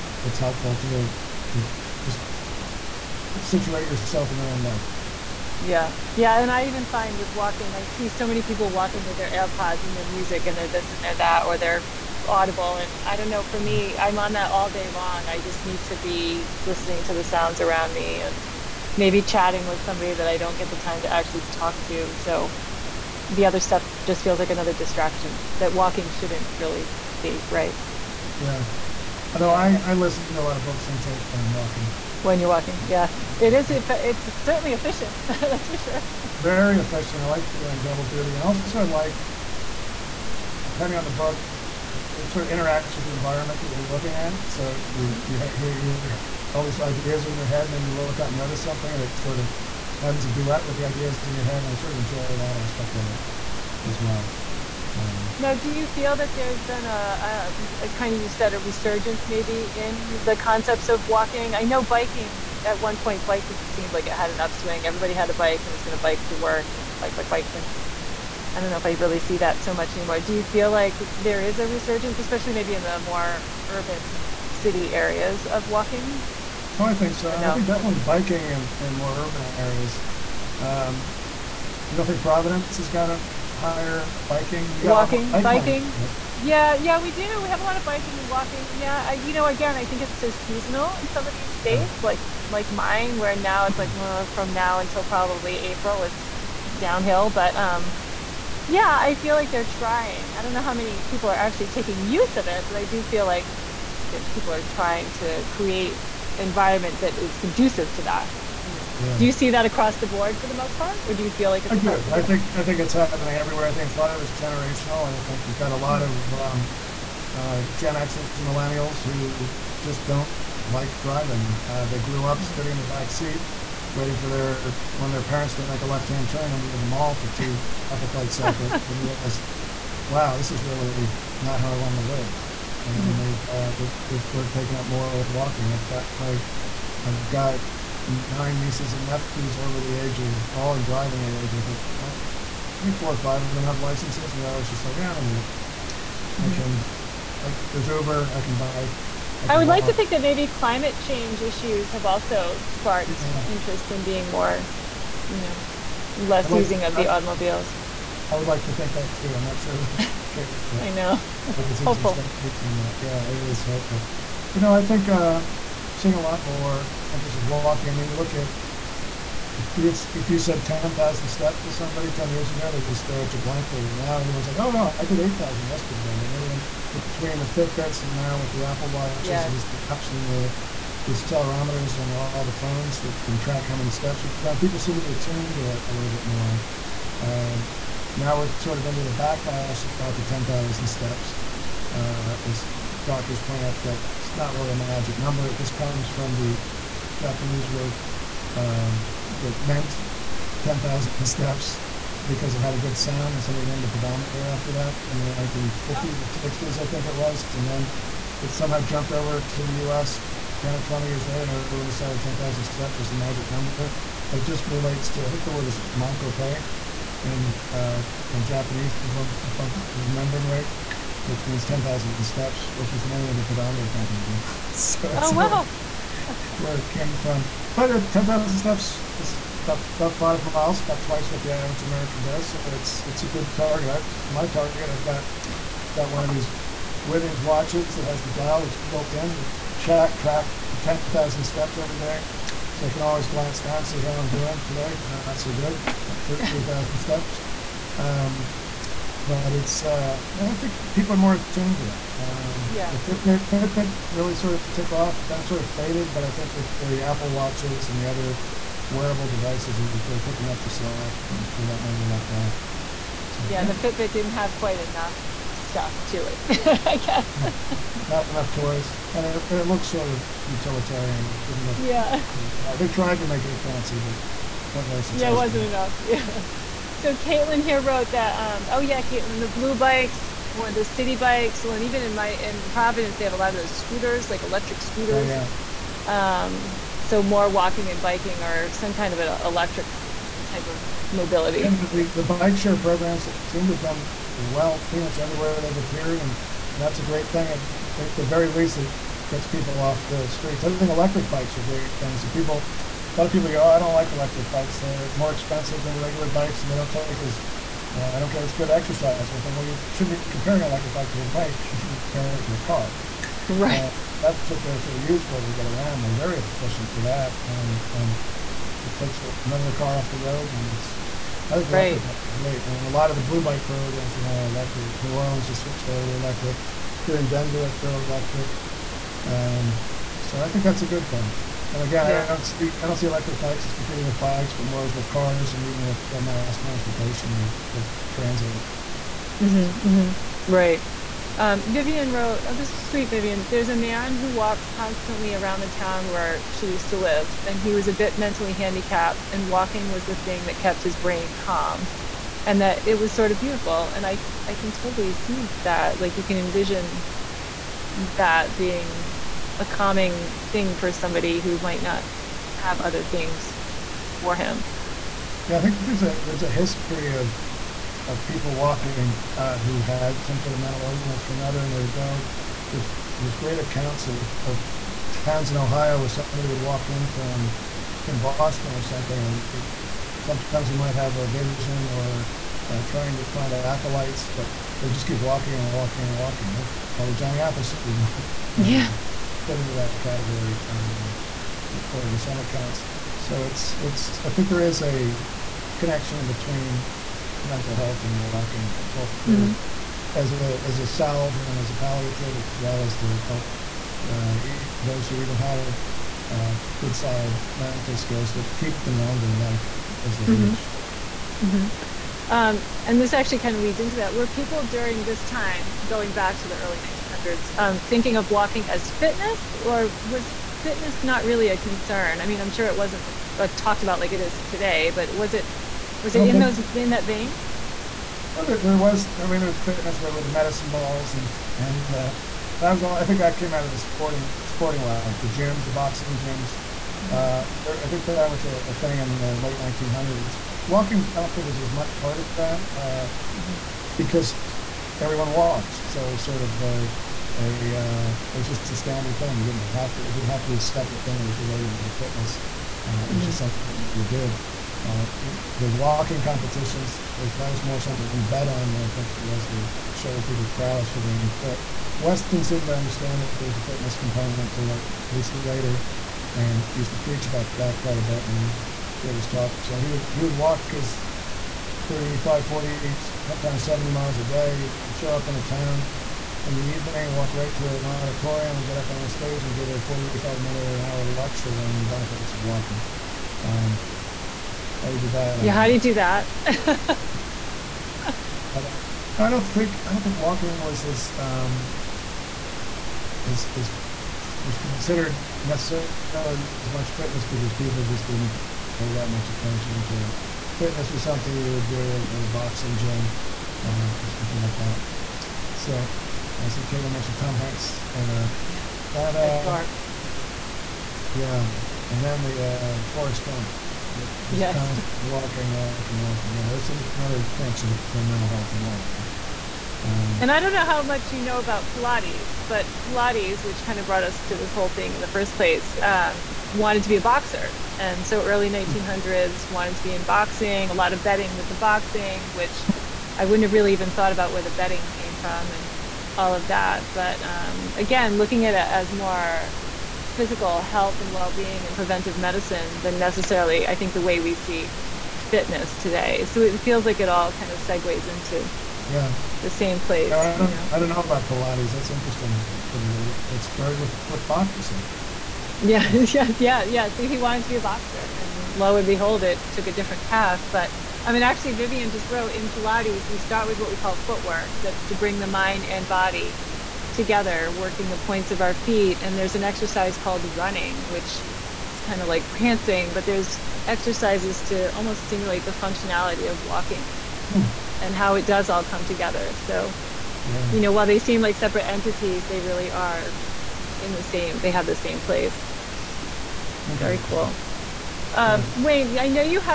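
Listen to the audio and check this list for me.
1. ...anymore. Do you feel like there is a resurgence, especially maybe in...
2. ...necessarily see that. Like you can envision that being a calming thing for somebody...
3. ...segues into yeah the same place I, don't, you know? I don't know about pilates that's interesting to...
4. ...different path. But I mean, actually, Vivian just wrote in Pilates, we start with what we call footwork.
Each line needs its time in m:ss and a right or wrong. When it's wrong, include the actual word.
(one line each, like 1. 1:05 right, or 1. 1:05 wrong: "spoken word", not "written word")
1. 1:09 right
2. 5:54 wrong: "totally", not "necessarily"
3. 9:07 right
4. 9:19 right.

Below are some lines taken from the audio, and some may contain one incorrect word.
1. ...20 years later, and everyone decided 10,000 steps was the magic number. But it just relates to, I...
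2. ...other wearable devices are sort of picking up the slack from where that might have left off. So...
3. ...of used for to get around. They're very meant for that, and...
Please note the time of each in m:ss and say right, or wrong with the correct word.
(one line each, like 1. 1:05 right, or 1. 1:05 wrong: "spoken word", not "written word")
1. 3:30 right
2. 4:18 right
3. 5:14 wrong: "efficient", not "meant".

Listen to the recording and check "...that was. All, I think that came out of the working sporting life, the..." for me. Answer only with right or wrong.
wrong.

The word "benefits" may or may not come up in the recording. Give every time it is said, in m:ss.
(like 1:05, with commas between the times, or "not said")
8:01.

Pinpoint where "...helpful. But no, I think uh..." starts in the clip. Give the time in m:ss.
2:43.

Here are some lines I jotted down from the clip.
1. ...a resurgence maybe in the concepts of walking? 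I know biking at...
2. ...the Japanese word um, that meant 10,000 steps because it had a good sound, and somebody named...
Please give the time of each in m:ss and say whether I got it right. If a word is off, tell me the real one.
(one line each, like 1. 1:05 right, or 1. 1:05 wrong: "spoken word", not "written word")
1. 0:58 right
2. 3:16 right.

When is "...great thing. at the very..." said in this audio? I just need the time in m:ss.
4:57.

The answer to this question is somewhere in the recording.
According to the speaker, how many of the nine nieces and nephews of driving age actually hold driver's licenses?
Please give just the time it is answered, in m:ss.
2:22.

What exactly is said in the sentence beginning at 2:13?
they've, uh, they've, they've sort of taken up more with walking.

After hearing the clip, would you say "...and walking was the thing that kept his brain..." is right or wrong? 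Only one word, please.
right.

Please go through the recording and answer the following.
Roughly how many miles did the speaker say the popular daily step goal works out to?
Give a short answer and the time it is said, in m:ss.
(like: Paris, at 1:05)
5 miles, at 3:50.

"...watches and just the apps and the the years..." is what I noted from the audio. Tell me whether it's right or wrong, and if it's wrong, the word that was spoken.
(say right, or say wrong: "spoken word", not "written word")
wrong: "accelerometers", not "years".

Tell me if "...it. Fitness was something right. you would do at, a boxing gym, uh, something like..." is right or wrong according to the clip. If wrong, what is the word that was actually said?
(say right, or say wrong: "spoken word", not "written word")
right.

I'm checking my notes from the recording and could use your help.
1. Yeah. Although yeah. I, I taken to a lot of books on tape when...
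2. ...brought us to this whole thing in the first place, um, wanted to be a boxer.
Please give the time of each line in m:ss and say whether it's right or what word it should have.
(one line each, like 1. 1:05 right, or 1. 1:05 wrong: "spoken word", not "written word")
1. 0:28 wrong: "listen", not "taken"
2. 8:43 right.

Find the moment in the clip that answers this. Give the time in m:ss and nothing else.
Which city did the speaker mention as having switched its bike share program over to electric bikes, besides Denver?
5:25.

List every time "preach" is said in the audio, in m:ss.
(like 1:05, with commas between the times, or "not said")
7:46.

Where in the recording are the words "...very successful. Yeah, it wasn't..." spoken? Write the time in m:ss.
4:34.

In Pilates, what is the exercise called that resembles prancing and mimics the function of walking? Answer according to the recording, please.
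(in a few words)
Running.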